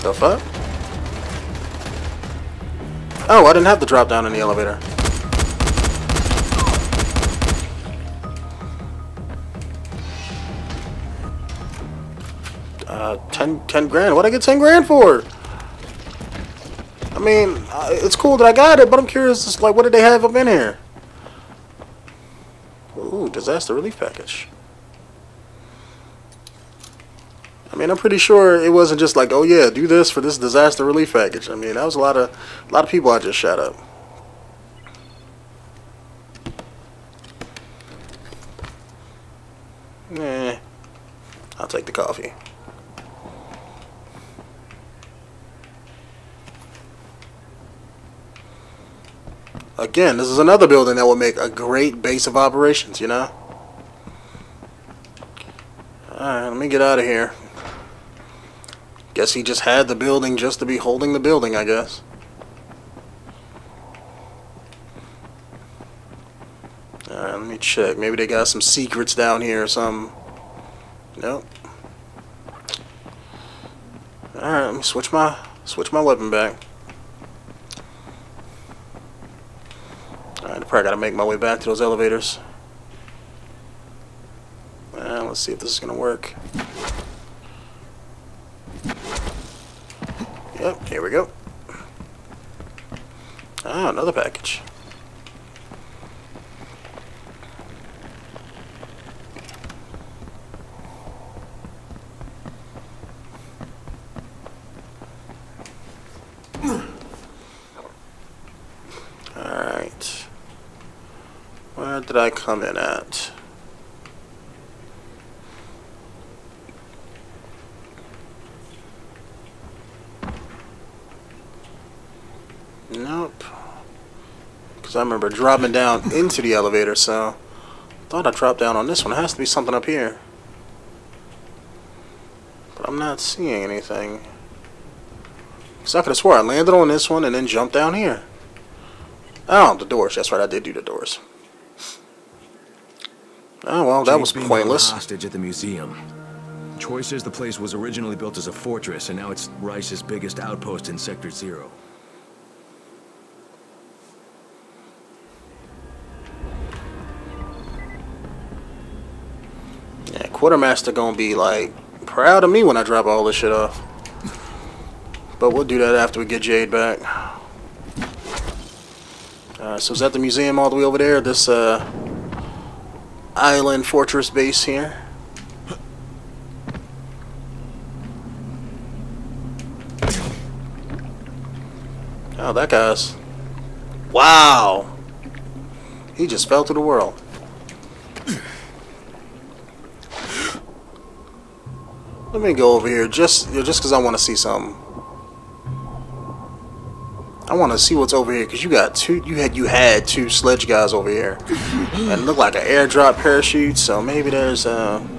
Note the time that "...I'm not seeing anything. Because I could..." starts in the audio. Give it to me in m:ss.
2:12.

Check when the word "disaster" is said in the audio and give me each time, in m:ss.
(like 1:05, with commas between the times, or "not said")
0:23, 0:30.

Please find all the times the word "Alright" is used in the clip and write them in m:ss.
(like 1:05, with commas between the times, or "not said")
0:56, 1:07, 1:14.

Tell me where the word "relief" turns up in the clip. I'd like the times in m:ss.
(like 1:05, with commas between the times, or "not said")
0:23, 0:30.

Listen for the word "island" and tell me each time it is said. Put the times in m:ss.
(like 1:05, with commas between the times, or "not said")
2:53.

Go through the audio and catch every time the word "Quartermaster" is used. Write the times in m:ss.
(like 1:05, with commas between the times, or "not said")
2:40.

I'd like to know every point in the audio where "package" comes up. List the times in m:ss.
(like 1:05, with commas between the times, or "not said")
0:23, 0:31, 1:34.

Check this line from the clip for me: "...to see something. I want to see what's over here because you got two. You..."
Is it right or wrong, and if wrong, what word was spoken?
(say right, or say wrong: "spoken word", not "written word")
right.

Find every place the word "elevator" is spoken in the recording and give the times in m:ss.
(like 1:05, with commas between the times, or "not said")
0:04, 1:21, 2:06.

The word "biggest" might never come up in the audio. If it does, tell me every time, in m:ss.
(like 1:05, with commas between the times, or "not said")
2:30.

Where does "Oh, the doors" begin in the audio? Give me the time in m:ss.
2:19.